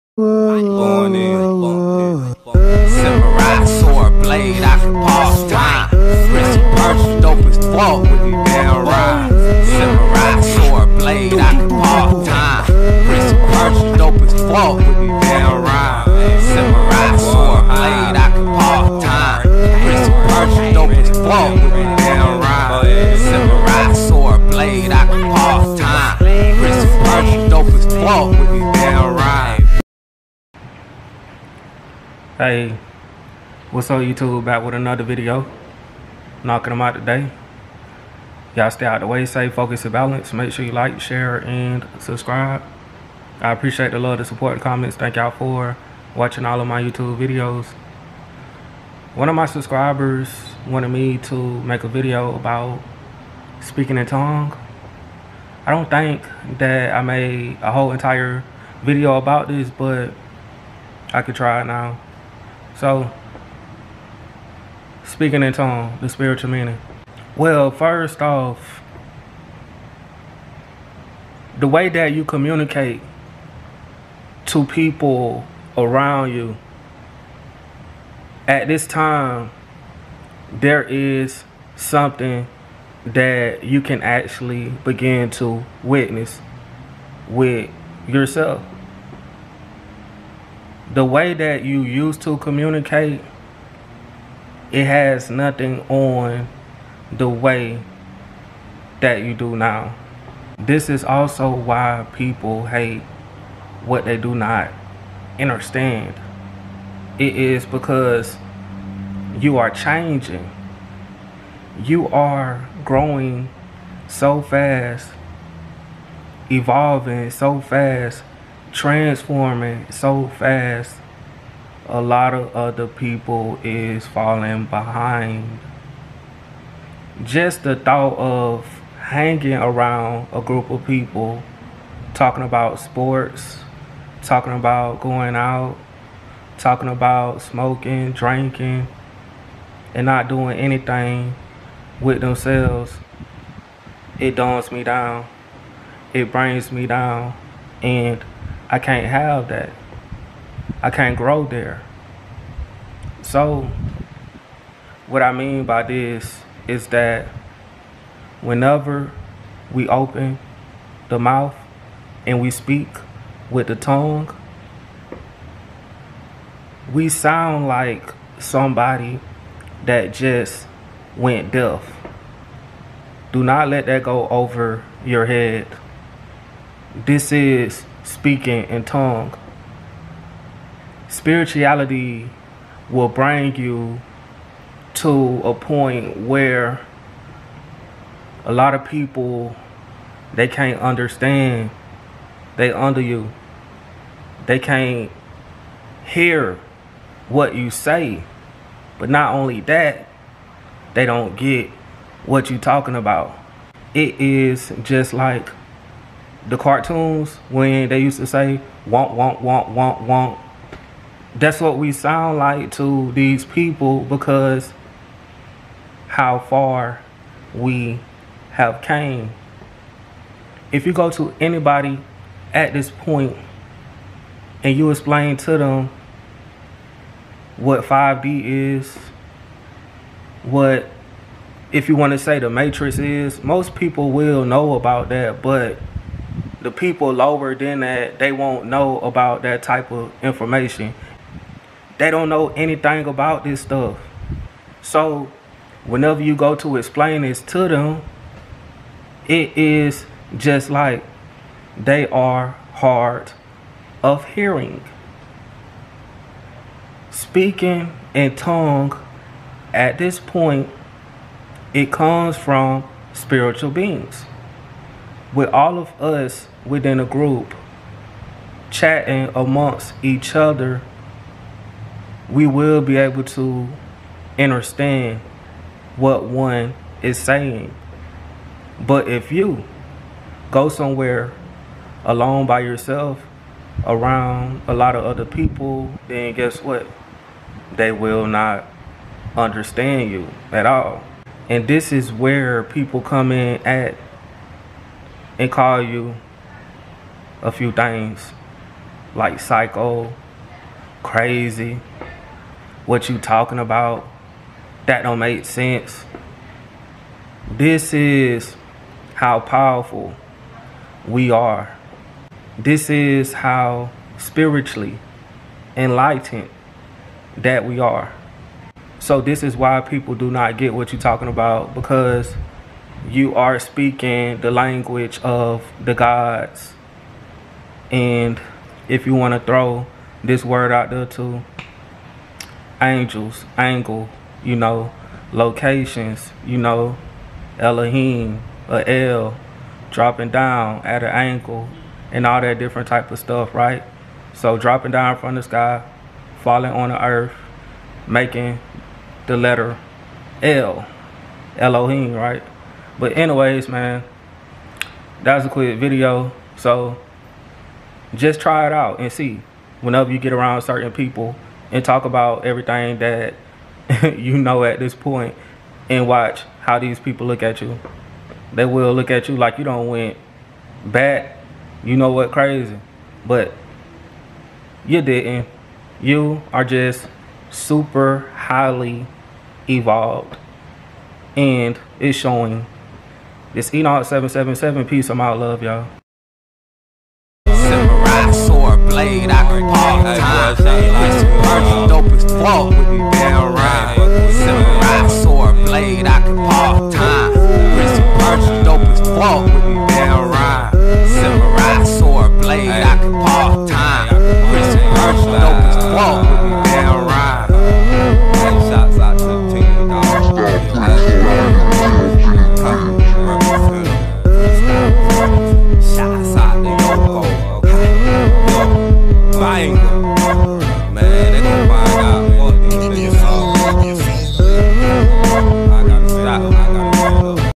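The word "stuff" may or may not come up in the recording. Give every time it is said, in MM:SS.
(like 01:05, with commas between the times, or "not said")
04:03, 05:43.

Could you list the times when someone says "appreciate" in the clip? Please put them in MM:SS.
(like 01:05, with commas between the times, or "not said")
00:43.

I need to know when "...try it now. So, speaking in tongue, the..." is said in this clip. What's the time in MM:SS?
01:01.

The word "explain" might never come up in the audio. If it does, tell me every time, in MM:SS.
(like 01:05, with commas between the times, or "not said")
03:44, 04:06.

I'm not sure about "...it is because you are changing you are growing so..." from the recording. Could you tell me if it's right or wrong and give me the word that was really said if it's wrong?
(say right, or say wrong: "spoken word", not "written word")
right.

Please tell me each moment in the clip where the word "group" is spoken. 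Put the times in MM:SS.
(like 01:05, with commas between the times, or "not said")
02:10, 04:27.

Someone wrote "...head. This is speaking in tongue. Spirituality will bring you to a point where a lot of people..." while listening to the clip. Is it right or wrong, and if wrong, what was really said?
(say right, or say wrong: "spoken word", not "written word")
right.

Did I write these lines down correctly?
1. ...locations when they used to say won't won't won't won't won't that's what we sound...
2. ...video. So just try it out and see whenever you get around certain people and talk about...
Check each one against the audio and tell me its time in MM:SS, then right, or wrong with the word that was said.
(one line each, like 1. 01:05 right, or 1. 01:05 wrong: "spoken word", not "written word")
1. 03:26 wrong: "cartoons", not "locations"
2. 05:55 right.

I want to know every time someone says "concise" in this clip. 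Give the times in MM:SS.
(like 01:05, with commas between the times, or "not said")
not said.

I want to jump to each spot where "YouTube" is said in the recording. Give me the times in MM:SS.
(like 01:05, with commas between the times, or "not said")
00:34, 00:46.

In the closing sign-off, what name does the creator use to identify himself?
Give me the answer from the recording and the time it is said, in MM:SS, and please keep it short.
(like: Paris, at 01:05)
Enoch 777, at 06:23.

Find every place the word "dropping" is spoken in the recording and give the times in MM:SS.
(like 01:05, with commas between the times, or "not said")
05:39, 05:44.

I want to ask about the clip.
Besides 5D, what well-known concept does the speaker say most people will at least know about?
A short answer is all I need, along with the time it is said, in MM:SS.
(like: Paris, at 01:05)
the Matrix, at 03:52.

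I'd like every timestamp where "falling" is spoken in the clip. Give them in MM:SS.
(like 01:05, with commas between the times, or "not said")
02:04, 05:46.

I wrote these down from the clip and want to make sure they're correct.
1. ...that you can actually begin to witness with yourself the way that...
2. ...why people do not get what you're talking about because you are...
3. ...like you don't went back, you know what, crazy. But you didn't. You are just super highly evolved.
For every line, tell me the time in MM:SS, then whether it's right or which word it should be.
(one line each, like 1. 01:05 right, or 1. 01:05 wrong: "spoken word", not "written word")
1. 01:23 right
2. 05:19 right
3. 06:09 right.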